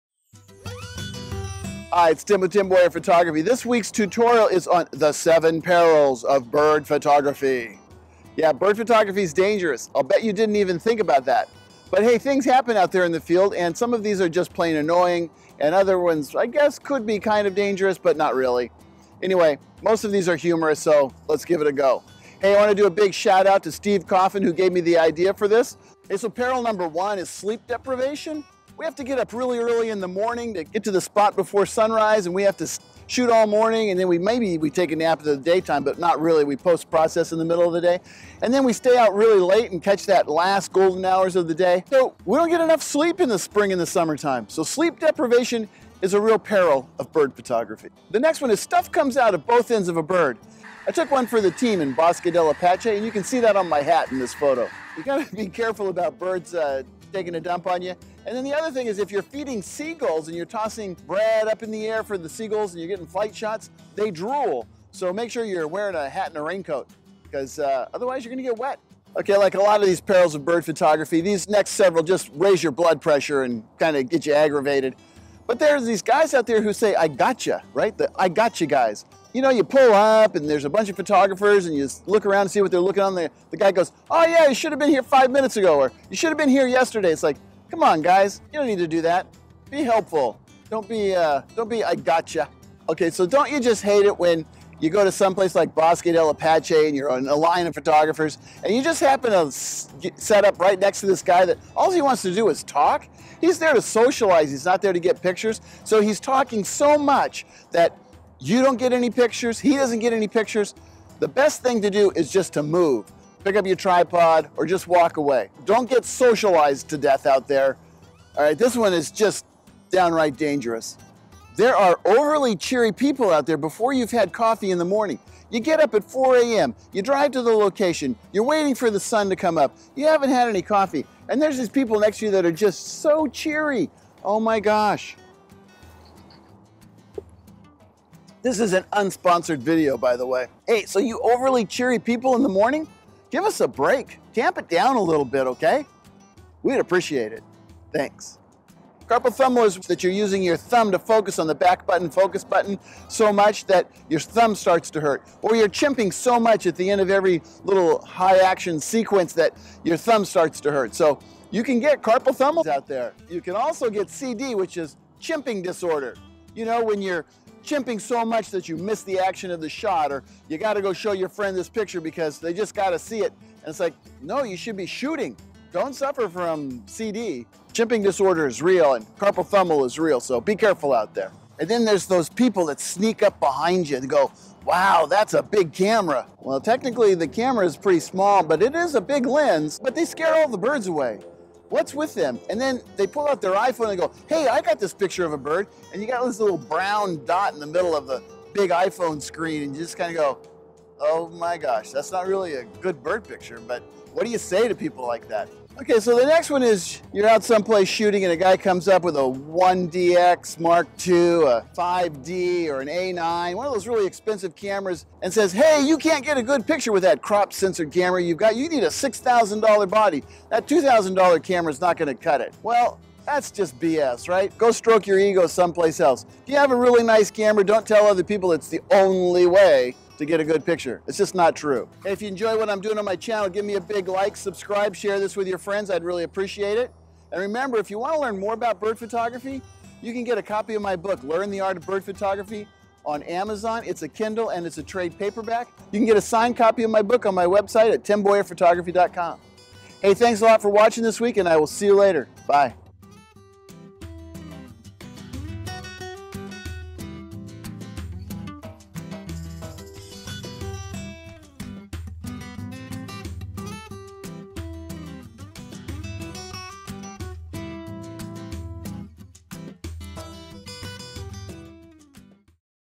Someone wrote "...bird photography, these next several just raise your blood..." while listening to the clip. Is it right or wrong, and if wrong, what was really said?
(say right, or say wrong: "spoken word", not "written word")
right.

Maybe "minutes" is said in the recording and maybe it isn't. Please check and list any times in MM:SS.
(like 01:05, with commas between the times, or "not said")
01:25.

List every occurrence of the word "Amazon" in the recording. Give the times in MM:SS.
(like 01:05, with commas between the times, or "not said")
04:03.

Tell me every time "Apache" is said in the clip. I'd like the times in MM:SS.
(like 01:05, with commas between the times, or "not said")
00:52, 01:36.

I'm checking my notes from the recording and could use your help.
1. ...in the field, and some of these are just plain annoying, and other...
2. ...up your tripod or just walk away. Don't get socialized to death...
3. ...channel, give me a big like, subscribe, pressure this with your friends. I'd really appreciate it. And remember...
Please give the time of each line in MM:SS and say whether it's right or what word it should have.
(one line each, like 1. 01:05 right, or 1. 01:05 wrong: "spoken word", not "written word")
1. 00:13 right
2. 01:53 right
3. 03:53 wrong: "share", not "pressure".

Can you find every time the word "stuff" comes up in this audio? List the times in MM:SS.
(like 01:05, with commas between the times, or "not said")
00:48.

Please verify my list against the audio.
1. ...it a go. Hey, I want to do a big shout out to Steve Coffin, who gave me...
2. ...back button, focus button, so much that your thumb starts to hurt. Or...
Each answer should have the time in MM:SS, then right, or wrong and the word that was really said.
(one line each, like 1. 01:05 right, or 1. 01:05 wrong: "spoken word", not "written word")
1. 00:21 right
2. 02:31 right.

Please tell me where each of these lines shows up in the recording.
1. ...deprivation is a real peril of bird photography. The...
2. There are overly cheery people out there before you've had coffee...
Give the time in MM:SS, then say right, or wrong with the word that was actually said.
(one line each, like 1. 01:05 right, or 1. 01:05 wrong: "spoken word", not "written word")
1. 00:44 right
2. 02:01 right.